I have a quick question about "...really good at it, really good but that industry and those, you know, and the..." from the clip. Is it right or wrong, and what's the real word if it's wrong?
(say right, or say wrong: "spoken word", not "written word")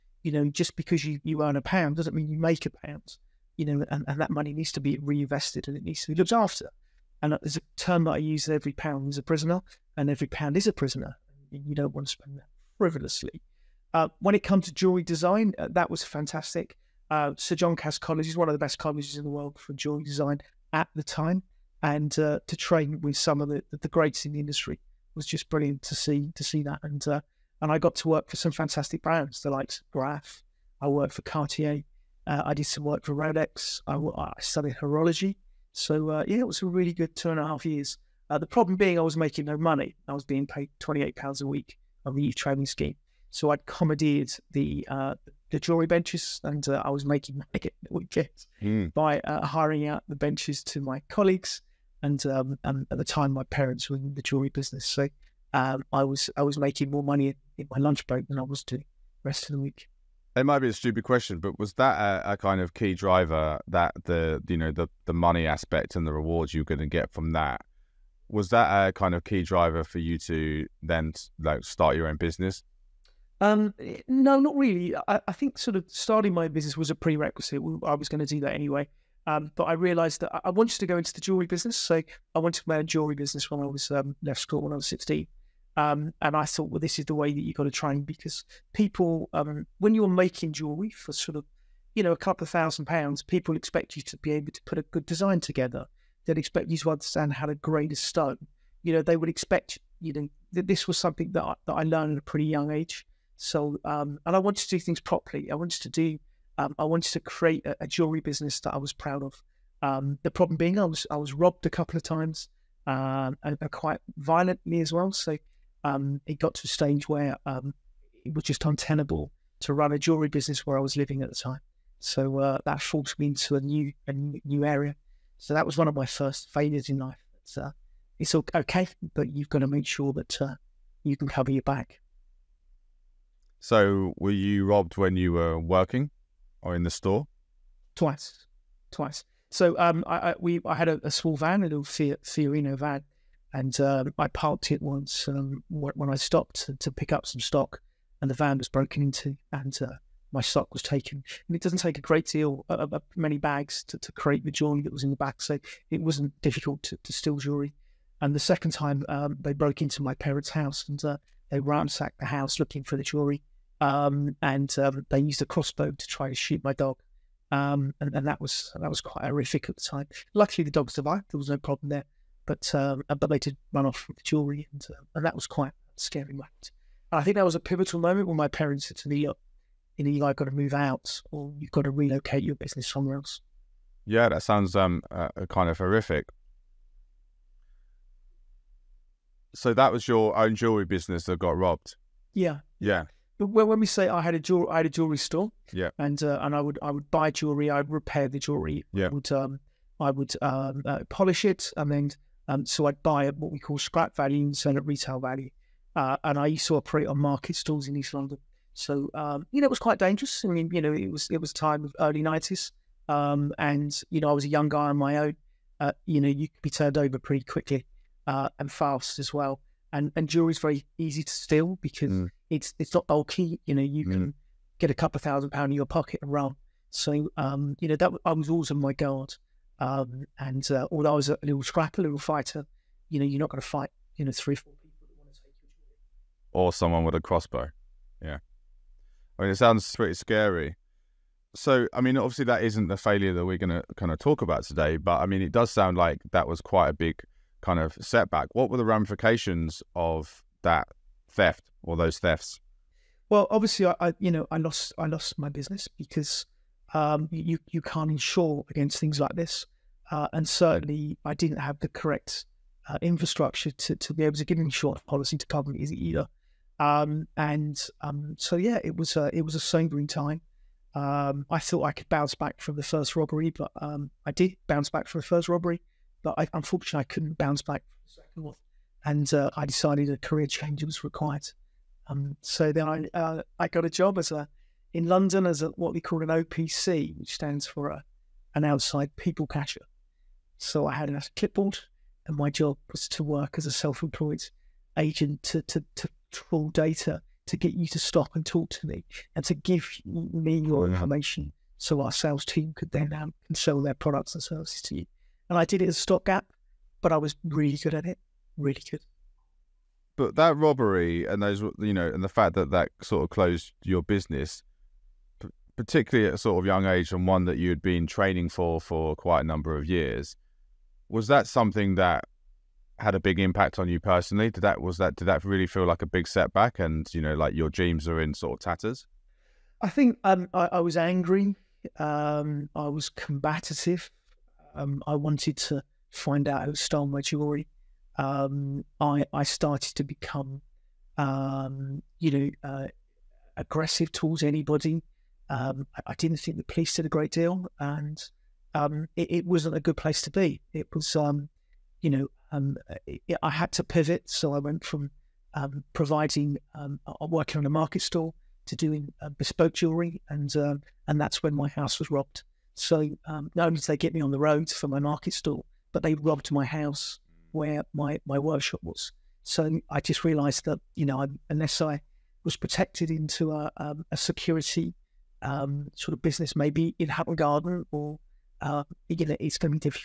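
wrong: "robbery", not "industry".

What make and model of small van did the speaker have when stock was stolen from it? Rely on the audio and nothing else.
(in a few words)
Fiat Fiorino.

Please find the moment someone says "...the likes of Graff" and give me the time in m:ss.
0:29.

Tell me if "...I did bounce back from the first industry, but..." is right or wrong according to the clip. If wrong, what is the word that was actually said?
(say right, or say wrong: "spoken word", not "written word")
wrong: "robbery", not "industry".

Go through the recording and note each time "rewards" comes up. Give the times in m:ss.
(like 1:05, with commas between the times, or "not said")
1:06.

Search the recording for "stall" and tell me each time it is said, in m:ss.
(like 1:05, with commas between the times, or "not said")
3:27, 5:58, 6:05.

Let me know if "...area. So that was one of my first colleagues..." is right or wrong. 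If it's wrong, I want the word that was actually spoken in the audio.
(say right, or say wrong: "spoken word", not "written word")
wrong: "failures", not "colleagues".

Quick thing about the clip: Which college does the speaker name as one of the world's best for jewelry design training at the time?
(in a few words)
Sir John Cass College.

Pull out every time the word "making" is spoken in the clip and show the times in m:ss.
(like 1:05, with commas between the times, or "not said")
0:39, 0:47, 0:56, 1:30.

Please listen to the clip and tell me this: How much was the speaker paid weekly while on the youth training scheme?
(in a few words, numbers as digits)
28 pounds.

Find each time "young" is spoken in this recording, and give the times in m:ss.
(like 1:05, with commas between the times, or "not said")
1:42, 3:34, 5:16.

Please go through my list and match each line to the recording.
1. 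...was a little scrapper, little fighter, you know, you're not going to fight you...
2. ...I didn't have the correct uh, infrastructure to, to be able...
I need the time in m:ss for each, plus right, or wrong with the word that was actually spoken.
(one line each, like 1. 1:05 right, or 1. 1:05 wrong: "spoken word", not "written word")
1. 3:51 right
2. 4:21 right.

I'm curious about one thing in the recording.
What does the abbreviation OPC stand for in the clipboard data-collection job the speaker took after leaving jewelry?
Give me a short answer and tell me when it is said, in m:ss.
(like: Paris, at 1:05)
outside people cashier, at 4:48.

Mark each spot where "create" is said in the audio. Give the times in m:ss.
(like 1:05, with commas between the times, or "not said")
1:47, 2:34.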